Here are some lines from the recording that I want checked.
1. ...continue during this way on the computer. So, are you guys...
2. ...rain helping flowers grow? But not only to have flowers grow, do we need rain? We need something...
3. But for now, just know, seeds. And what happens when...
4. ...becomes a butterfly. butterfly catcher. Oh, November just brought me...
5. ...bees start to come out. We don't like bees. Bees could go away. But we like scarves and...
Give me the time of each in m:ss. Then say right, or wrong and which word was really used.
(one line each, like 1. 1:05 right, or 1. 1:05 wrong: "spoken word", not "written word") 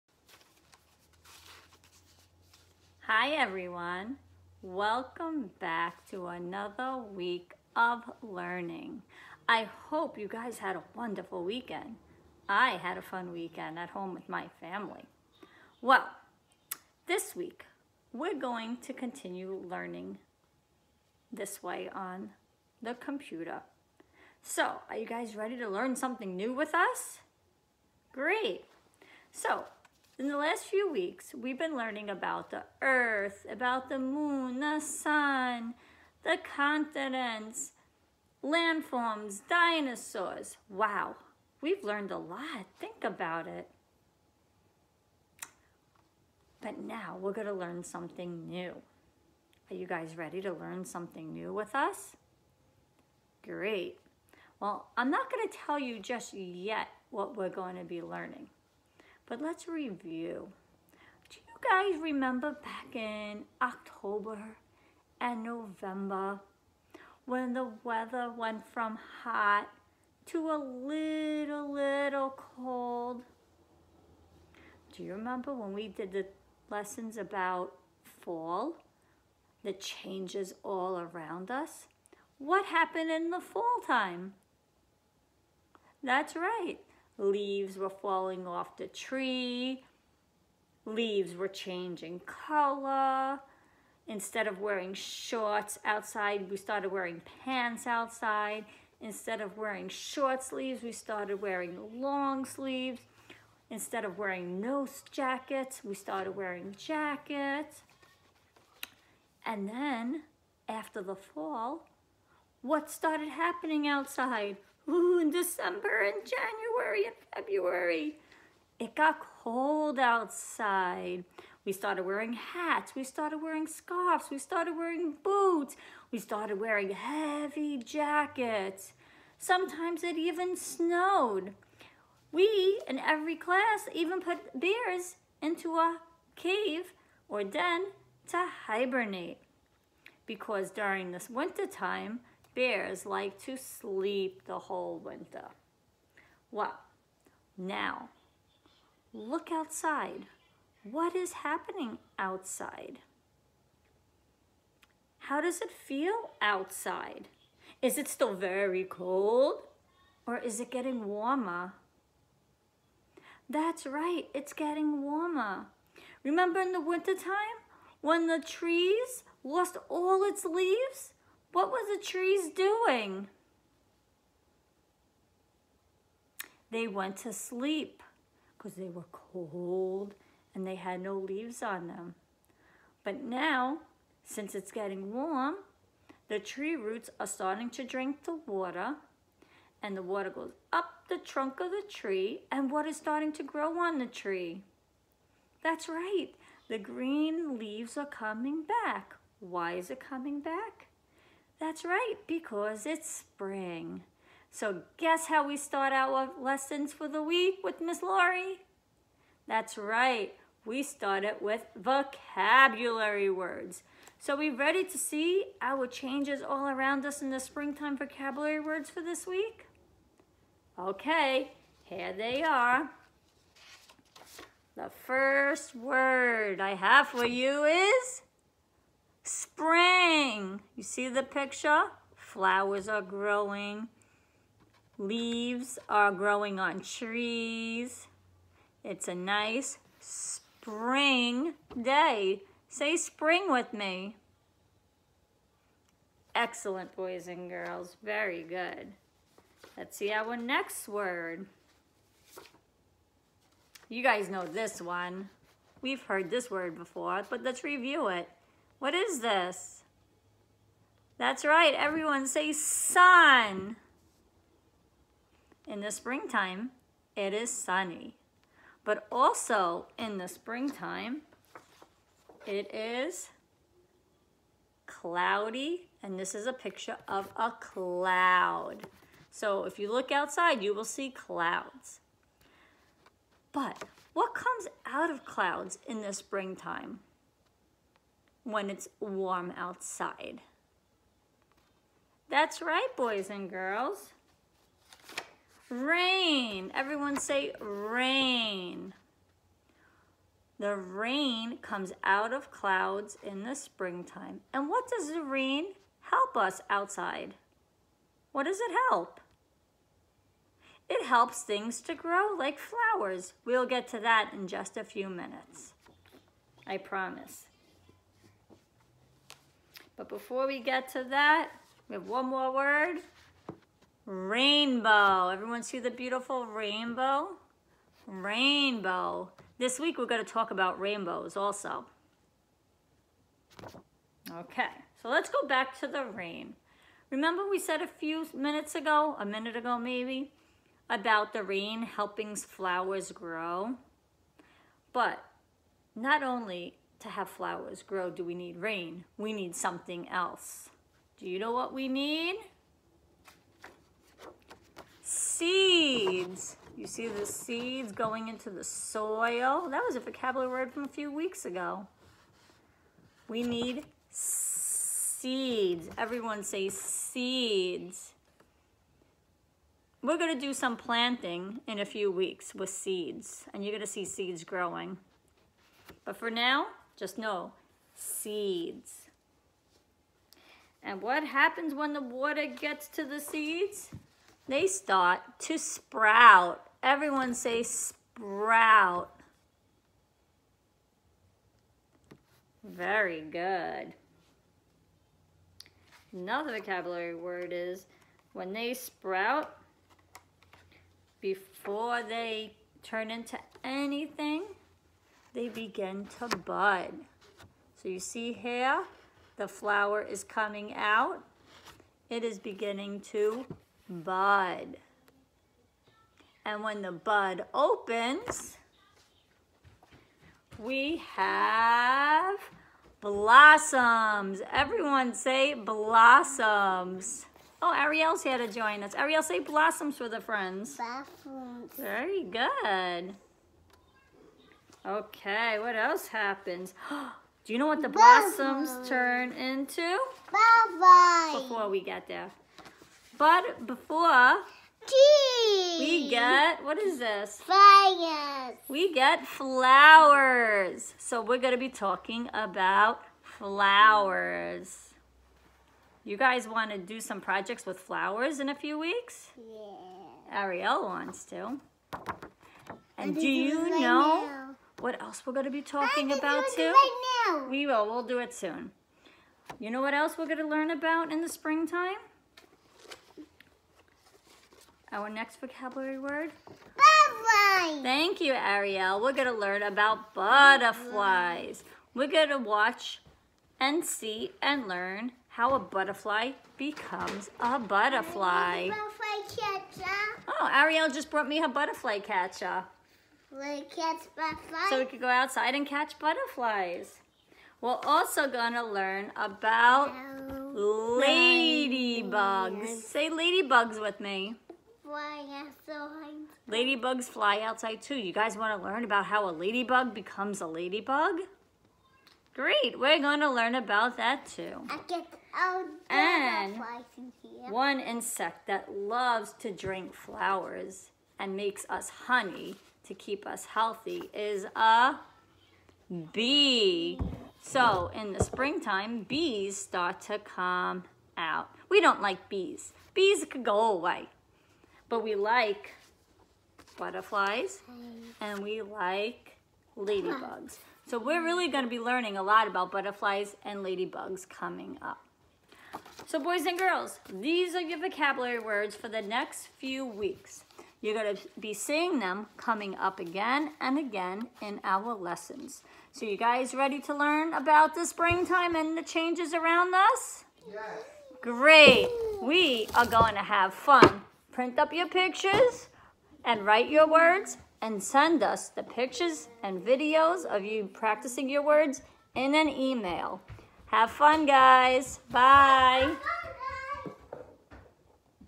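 1. 0:18 wrong: "learning", not "during"
2. 5:41 right
3. 6:16 right
4. 8:06 wrong: "Ariel", not "November"
5. 8:49 wrong: "butterflies", not "scarves".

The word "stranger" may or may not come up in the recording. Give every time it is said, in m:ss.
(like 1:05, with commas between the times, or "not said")
not said.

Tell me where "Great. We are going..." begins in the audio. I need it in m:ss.
9:21.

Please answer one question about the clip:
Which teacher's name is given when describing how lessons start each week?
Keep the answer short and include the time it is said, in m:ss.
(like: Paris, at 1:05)
Miss Laurie, at 3:27.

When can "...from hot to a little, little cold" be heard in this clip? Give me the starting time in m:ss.
1:08.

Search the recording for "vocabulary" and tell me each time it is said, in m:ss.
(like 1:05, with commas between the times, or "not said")
3:31, 3:37, 5:59, 6:36, 7:55, 9:07.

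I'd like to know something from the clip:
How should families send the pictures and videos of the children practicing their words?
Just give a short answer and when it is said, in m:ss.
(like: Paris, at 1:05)
In an email, at 9:32.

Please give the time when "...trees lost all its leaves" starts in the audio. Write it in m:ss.
2:48.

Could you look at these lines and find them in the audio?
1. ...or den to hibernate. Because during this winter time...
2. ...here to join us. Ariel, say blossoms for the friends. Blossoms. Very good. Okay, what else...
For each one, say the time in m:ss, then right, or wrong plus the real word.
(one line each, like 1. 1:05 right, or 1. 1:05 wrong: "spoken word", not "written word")
1. 2:17 right
2. 7:08 right.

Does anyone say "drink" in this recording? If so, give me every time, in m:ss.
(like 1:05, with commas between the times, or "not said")
3:07, 8:39.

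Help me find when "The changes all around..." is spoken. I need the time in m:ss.
1:19.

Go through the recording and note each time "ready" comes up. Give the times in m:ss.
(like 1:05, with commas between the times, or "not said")
0:25, 0:50, 3:34, 9:16.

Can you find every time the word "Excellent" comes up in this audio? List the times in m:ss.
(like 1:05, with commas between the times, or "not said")
4:06.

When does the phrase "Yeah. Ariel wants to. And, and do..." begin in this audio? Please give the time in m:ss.
7:39.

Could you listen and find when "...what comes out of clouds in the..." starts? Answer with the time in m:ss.
4:44.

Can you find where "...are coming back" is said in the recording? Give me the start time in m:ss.
3:17.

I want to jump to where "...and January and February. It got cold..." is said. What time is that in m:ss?
1:56.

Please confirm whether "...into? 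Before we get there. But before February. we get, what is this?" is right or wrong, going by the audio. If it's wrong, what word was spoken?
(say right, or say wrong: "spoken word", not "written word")
wrong: "Tea", not "February".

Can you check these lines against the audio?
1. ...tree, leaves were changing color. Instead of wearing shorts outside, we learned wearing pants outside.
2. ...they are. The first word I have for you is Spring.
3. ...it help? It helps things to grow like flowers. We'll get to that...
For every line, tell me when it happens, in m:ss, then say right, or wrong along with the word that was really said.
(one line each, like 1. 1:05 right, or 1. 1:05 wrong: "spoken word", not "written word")
1. 1:28 wrong: "started", not "learned"
2. 3:42 right
3. 5:08 right.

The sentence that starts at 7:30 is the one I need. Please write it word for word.
So we're going to be talking about flowers.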